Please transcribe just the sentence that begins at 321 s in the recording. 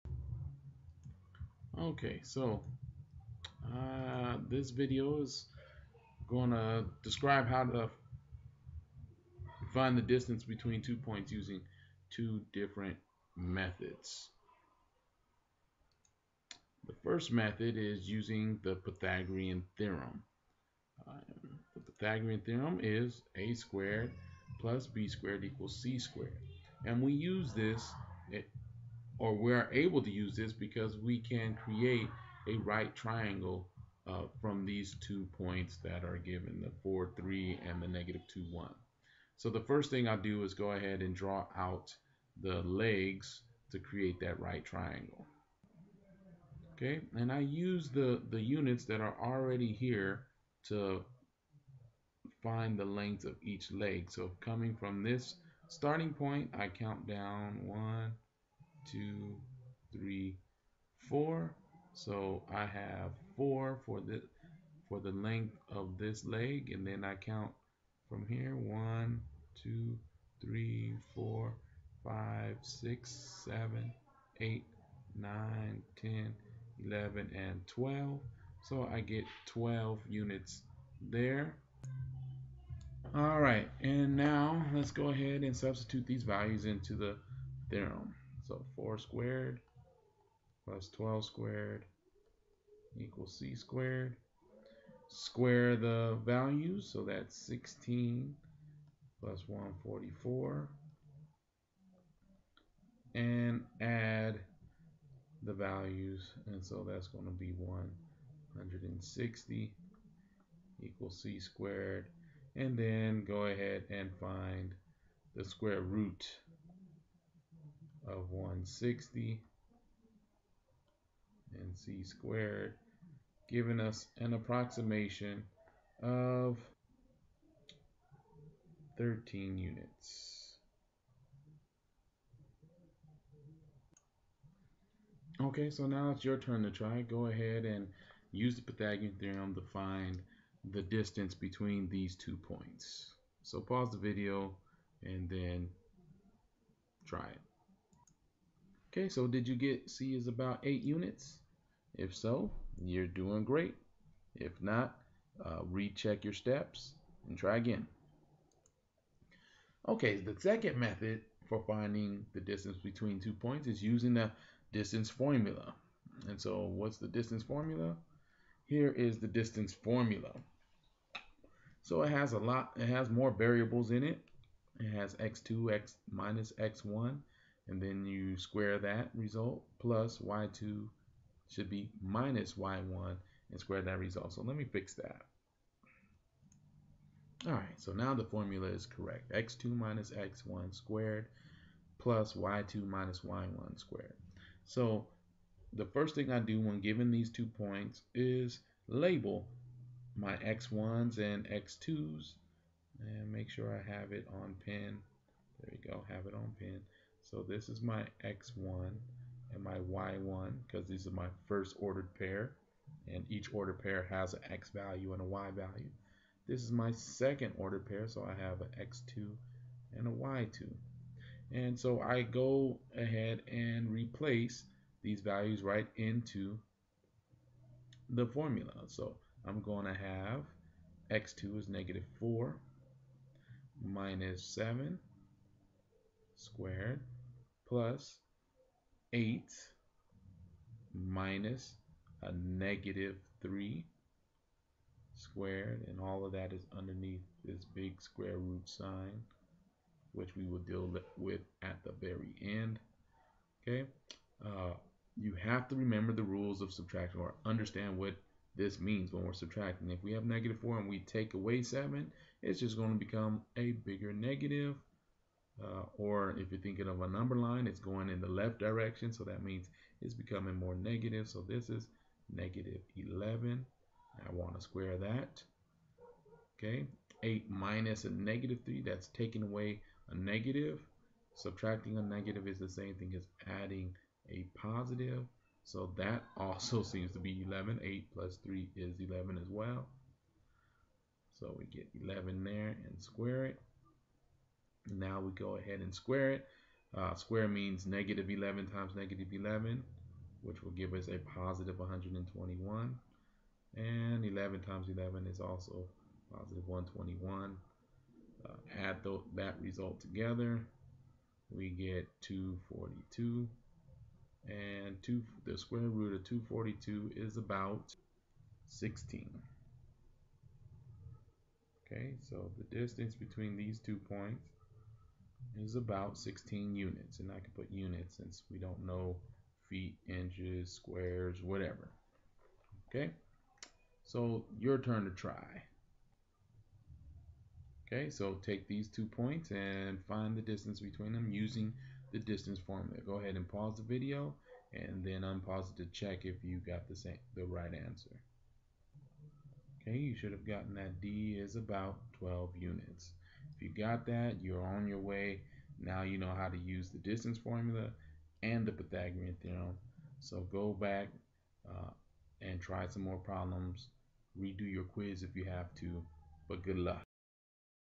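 Okay, so the distance between these two points is about 16 units.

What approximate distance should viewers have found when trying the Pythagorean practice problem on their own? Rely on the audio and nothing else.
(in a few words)
About 8 units.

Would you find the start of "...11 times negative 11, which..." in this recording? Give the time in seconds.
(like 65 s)
298 s.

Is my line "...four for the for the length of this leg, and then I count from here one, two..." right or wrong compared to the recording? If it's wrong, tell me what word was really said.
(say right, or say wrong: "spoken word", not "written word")
right.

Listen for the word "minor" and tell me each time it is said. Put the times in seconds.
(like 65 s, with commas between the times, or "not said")
not said.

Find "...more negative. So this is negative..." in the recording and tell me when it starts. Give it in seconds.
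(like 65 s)
270 s.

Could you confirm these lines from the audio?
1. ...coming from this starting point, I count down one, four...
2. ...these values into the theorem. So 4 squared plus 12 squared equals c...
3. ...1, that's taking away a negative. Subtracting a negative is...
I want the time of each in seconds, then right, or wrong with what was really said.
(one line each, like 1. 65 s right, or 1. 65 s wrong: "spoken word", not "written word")
1. 54 s wrong: "two", not "four"
2. 86 s right
3. 278 s wrong: "3", not "1".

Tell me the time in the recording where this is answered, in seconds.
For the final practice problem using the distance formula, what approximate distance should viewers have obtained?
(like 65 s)
351 s.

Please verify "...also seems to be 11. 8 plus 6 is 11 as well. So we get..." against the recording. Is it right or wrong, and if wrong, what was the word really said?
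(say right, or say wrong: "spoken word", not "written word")
wrong: "3", not "6".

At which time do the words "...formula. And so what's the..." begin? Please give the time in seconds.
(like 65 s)
165 s.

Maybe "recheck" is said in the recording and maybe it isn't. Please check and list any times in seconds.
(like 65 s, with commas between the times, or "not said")
155 s.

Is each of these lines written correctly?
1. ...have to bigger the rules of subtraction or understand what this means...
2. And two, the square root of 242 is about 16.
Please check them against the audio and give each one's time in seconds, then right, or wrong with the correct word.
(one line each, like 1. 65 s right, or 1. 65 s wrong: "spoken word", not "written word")
1. 255 s wrong: "remember", not "bigger"
2. 314 s right.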